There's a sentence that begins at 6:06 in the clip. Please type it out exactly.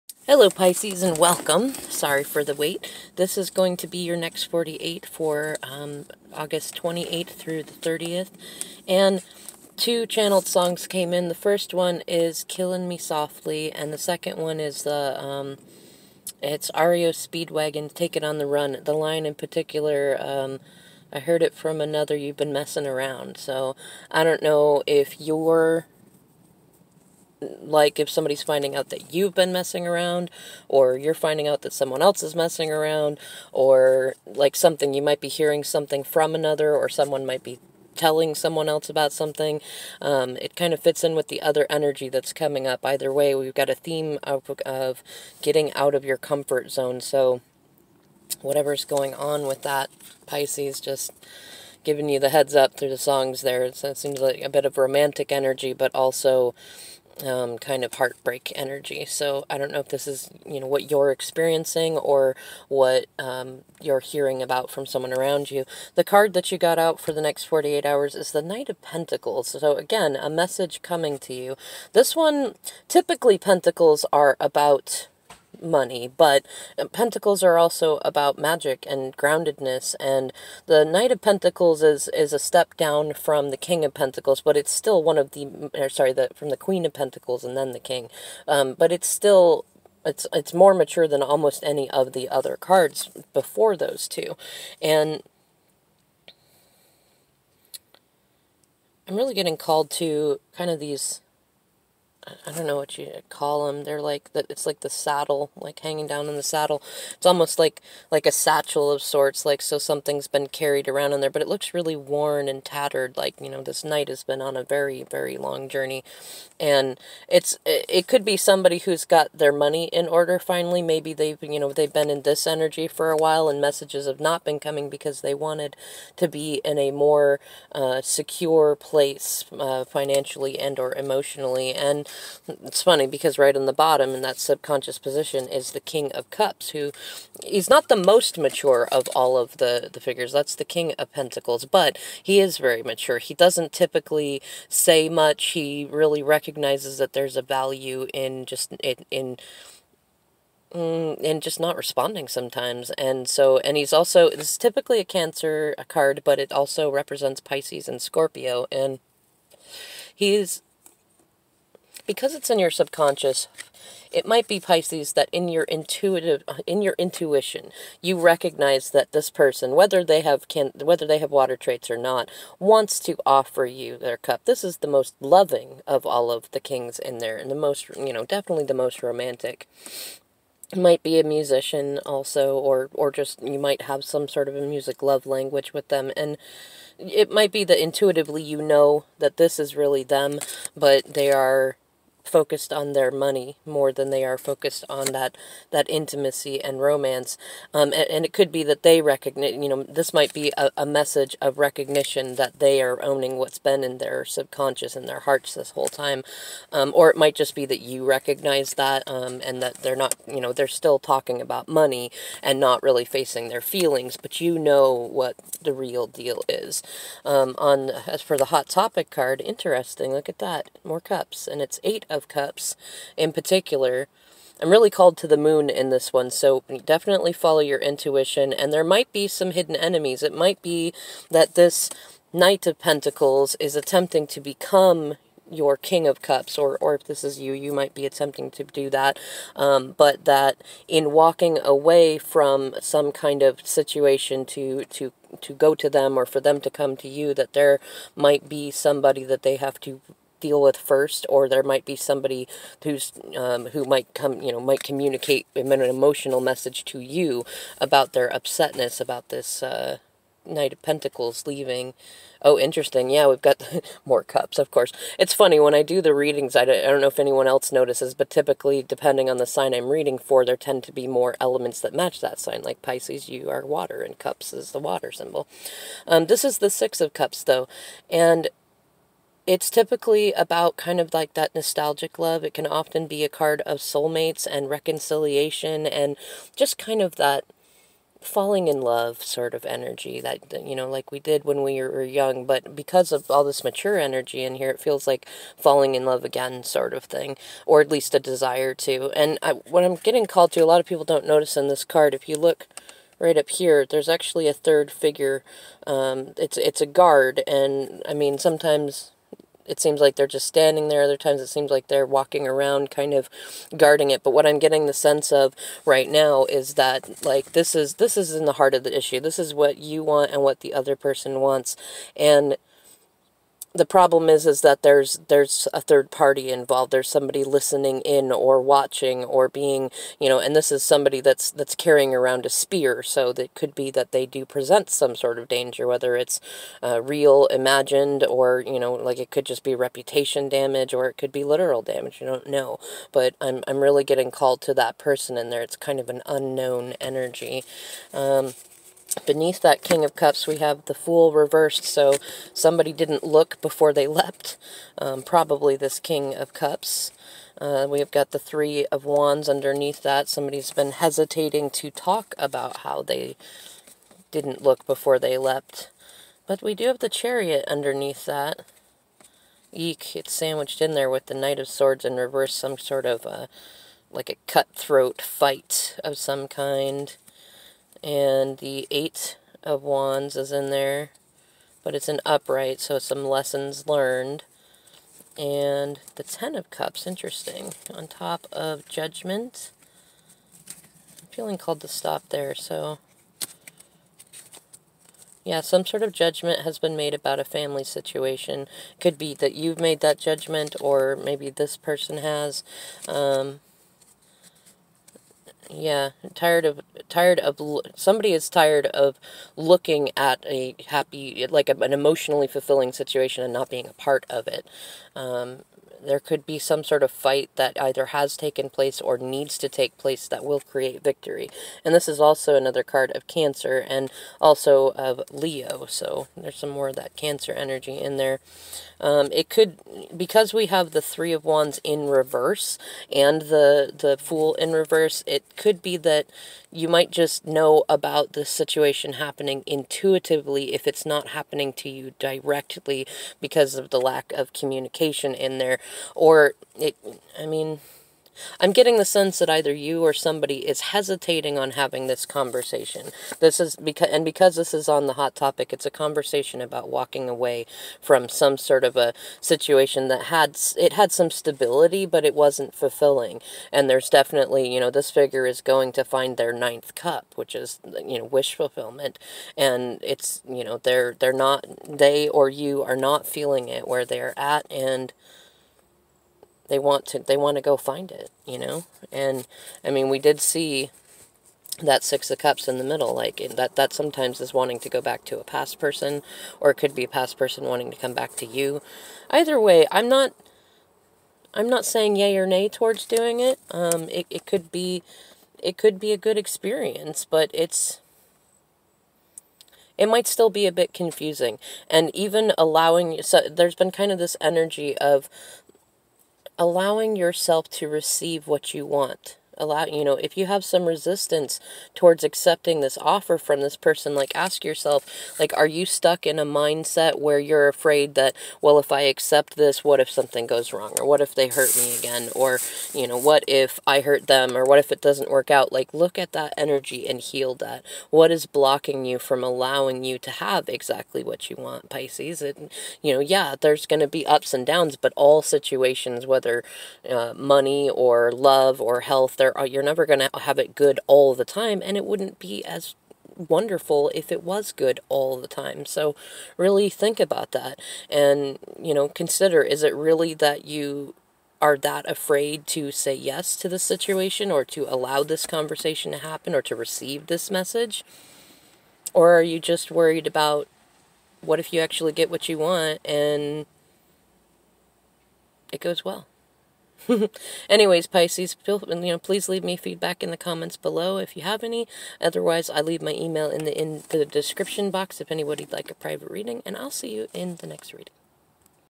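But we do have the Chariot underneath that.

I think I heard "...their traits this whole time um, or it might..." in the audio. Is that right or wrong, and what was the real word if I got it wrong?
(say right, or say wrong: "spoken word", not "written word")
wrong: "hearts", not "traits".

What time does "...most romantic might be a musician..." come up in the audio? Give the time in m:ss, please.
2:58.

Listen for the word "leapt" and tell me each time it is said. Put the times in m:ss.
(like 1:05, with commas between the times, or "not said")
5:54, 6:05.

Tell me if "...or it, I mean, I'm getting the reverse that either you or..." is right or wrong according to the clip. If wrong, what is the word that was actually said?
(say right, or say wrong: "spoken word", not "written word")
wrong: "sense", not "reverse".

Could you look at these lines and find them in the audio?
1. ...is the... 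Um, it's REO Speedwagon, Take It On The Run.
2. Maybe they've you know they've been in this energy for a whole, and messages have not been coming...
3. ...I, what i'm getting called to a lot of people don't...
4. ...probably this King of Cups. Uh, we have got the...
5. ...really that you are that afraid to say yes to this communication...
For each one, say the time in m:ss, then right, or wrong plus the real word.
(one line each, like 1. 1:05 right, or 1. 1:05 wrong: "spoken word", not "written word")
1. 0:14 right
2. 2:00 wrong: "while", not "whole"
3. 4:59 right
4. 5:55 right
5. 9:09 wrong: "situation", not "communication".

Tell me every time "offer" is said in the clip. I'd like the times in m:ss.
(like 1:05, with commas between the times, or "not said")
2:53, 8:32.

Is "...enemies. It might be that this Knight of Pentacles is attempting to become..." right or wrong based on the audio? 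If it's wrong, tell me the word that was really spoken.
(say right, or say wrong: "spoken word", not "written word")
right.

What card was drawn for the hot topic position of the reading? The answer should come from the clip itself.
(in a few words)
Eight of Cups.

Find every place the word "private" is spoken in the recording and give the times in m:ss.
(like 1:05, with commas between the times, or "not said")
9:35.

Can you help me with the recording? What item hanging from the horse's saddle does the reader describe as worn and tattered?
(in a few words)
satchel.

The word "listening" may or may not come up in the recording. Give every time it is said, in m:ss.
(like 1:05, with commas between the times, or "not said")
5:27.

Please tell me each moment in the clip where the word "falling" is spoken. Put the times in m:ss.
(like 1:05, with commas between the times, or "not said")
4:48, 4:55.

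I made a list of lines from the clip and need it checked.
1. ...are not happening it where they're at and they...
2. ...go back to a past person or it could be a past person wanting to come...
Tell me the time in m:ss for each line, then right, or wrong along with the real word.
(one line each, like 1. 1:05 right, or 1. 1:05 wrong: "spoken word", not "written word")
1. 7:52 wrong: "feeling", not "happening"
2. 8:04 right.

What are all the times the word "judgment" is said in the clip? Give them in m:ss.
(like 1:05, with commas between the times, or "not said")
6:28, 6:36, 6:40.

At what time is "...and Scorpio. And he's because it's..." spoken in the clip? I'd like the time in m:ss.
2:37.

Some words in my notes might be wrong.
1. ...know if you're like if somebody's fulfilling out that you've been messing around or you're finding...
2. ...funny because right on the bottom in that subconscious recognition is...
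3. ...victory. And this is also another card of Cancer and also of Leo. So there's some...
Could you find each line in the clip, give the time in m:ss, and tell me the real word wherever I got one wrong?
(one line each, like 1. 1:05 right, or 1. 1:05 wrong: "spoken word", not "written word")
1. 0:24 wrong: "finding", not "fulfilling"
2. 2:12 wrong: "position", not "recognition"
3. 7:01 right.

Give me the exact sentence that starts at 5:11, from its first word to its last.
Other times it seems like they're walking around kind of guarding it.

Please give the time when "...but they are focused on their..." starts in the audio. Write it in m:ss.
3:10.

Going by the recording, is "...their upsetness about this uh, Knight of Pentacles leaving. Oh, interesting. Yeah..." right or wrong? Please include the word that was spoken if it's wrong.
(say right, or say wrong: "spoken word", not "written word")
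right.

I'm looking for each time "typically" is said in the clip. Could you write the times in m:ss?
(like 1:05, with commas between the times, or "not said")
1:12, 2:23, 2:34, 4:28, 4:39.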